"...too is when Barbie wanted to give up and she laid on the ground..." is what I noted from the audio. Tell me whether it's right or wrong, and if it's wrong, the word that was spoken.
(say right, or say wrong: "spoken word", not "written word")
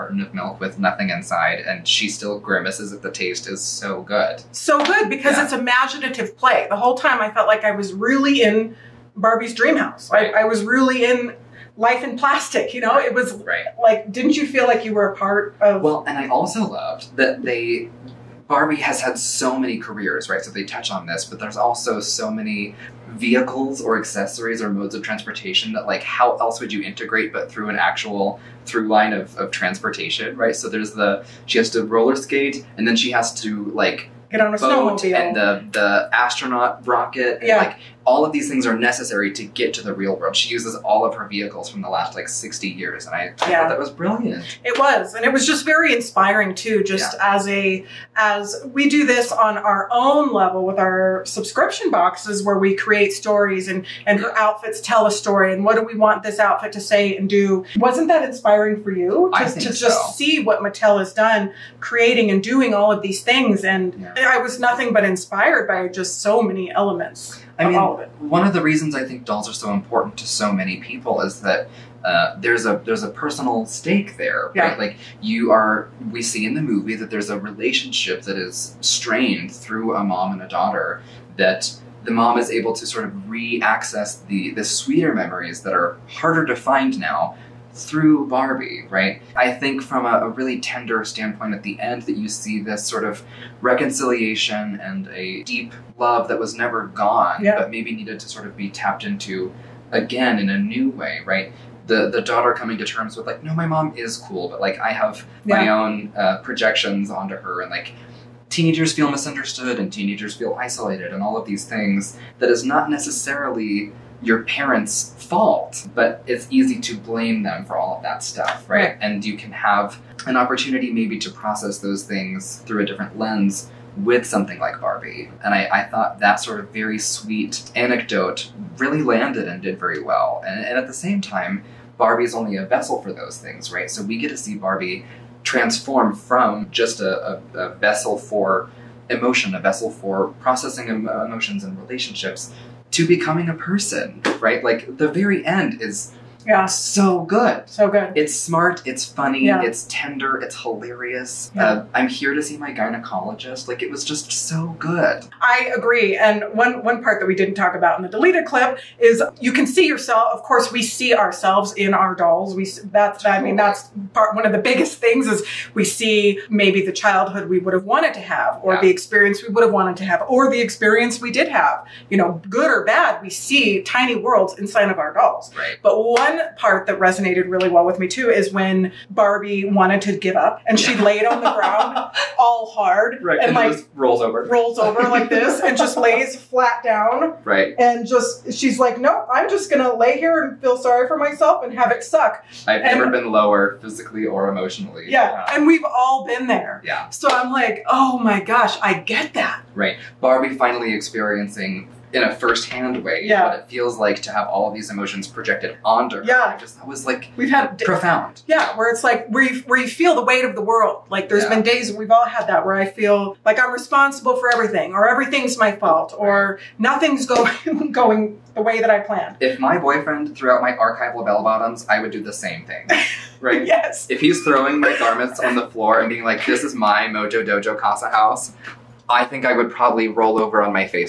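right.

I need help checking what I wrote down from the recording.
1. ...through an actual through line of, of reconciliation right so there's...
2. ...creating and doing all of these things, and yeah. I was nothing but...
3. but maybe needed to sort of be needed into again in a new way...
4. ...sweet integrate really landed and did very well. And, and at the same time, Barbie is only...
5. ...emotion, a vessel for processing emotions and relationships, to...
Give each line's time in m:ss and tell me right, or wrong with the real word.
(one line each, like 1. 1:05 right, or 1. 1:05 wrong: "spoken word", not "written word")
1. 0:27 wrong: "transportation", not "reconciliation"
2. 1:01 right
3. 1:37 wrong: "tapped", not "needed"
4. 2:06 wrong: "anecdote", not "integrate"
5. 2:19 right.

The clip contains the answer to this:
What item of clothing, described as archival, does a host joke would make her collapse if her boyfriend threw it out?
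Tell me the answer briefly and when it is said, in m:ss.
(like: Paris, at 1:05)
Bell bottoms, at 3:41.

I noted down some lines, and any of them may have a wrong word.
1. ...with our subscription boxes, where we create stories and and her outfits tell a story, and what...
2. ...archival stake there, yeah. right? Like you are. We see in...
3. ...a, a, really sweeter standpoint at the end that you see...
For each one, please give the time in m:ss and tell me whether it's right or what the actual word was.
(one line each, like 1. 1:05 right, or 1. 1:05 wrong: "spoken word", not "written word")
1. 0:50 right
2. 1:13 wrong: "personal", not "archival"
3. 1:30 wrong: "tender", not "sweeter".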